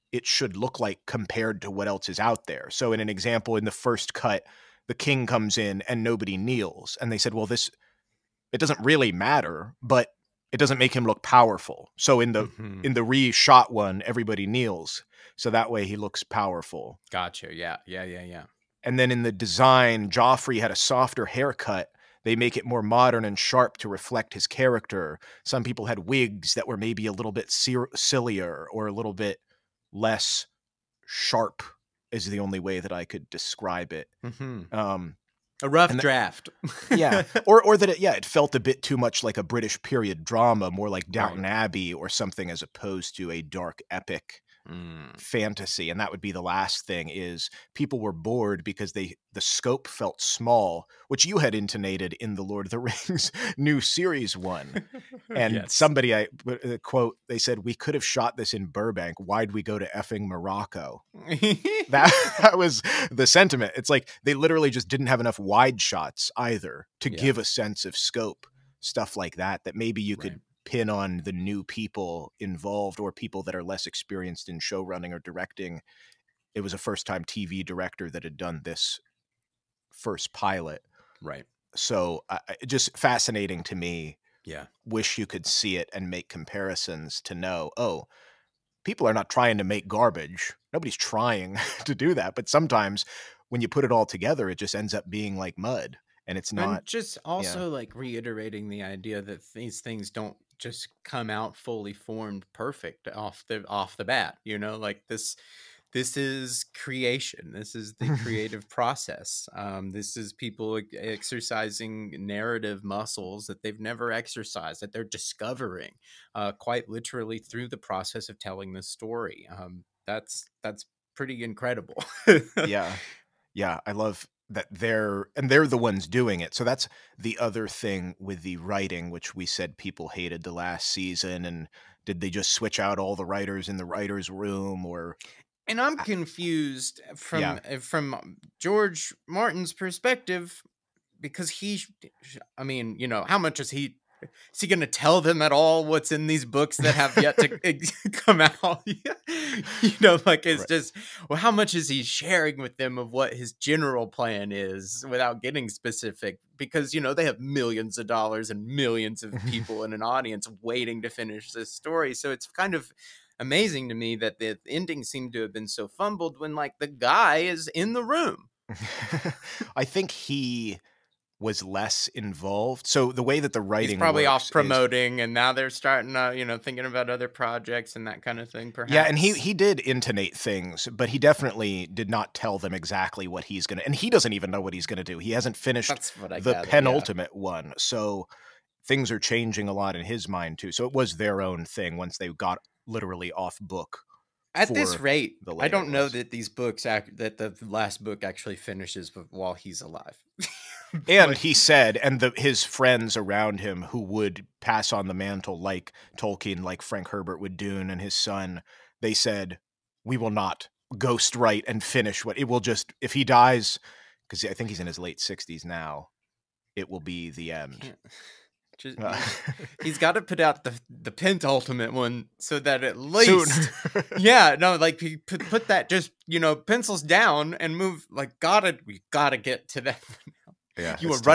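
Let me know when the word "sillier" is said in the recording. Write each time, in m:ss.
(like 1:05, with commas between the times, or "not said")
0:27.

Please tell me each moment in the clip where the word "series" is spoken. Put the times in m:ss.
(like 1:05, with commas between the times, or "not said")
0:53.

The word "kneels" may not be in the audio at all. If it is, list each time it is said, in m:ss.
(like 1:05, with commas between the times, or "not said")
0:06, 0:14.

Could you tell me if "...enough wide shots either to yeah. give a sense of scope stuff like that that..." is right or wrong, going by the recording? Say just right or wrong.
right.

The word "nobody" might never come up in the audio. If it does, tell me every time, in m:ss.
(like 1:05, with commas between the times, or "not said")
0:06, 1:30.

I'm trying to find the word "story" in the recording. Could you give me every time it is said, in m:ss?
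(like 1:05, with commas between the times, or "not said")
1:58, 2:41.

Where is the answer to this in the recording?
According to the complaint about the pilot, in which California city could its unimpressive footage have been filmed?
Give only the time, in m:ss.
0:58.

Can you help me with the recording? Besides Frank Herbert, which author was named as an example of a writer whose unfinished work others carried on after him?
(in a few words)
Tolkien.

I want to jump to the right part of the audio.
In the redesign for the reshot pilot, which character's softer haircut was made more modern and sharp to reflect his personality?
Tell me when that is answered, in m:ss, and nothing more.
0:20.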